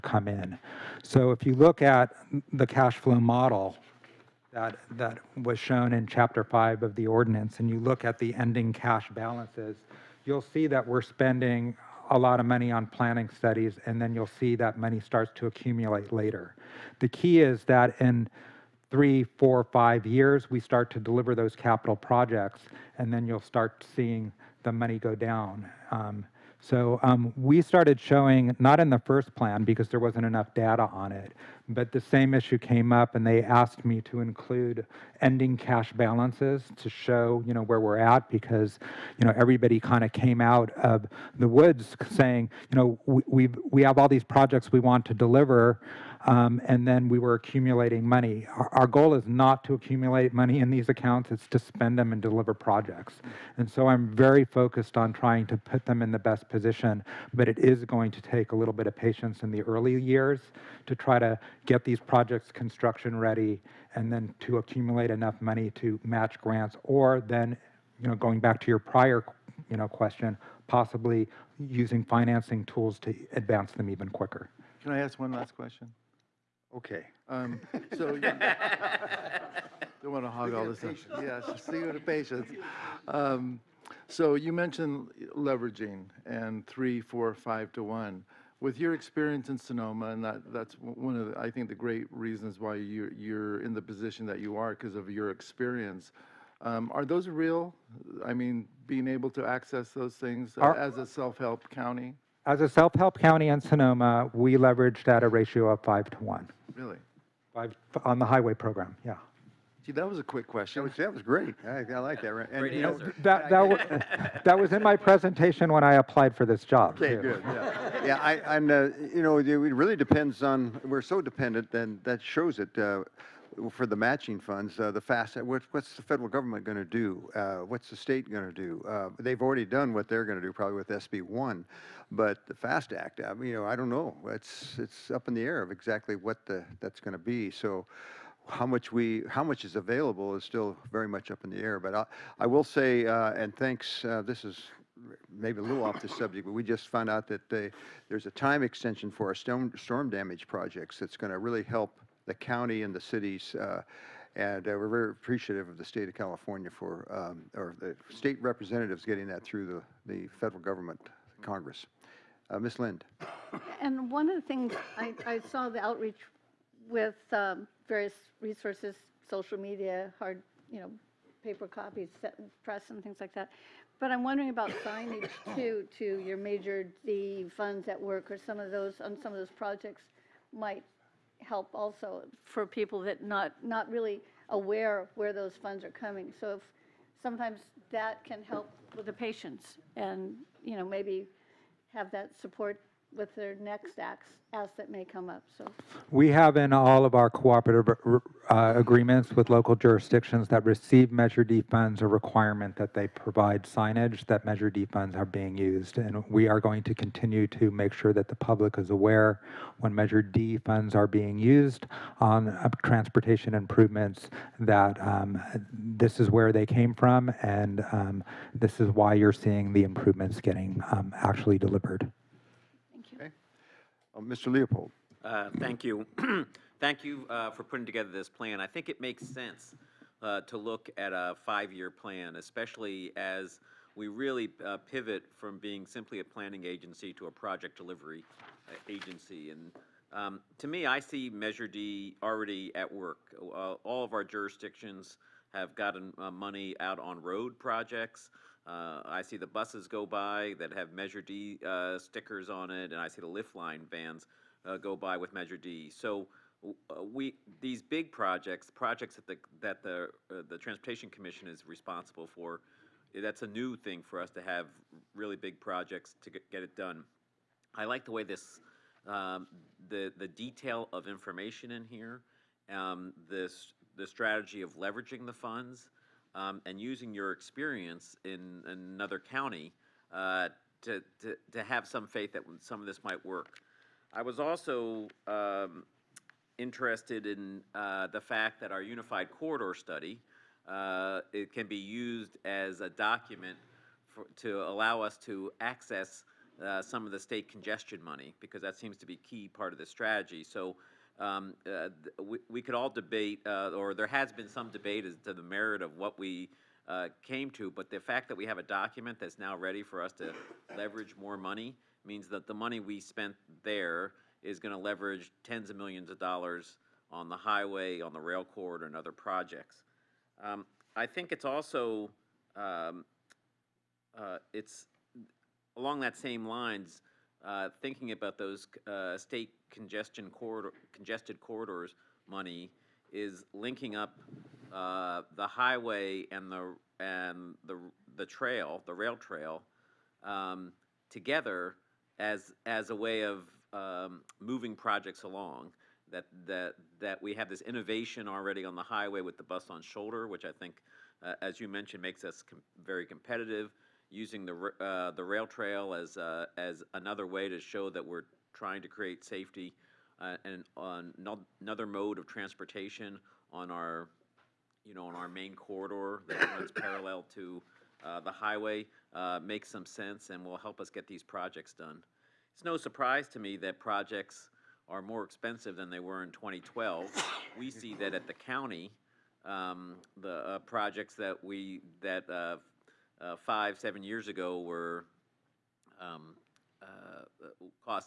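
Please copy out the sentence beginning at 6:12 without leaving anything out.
It's no surprise to me that projects are more expensive than they were in 2012.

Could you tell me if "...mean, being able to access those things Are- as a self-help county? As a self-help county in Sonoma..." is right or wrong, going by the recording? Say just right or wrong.
right.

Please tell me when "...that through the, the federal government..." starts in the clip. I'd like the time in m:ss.
2:39.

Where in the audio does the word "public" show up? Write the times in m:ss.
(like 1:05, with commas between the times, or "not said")
3:28.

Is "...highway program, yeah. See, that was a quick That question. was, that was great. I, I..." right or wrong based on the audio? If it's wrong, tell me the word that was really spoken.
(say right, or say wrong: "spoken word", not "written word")
right.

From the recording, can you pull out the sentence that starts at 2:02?
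uh, for the matching funds, uh, the FAST, Act, uh, what, what's the federal government going to do?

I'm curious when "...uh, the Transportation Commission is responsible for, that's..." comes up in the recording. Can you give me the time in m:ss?
4:20.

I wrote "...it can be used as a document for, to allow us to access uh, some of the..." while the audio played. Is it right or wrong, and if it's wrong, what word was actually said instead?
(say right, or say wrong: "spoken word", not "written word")
right.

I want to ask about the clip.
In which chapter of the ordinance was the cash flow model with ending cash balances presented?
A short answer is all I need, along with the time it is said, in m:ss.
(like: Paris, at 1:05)
Chapter 5, at 0:06.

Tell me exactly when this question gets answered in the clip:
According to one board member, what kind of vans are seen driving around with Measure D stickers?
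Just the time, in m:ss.
4:13.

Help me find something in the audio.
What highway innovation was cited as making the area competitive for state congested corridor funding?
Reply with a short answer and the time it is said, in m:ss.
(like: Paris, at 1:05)
bus on shoulder, at 5:49.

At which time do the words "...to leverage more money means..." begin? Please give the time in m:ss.
5:10.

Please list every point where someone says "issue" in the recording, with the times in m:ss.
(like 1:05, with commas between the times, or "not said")
0:32.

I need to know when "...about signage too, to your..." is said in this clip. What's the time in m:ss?
2:54.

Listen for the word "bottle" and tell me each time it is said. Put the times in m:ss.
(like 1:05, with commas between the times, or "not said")
not said.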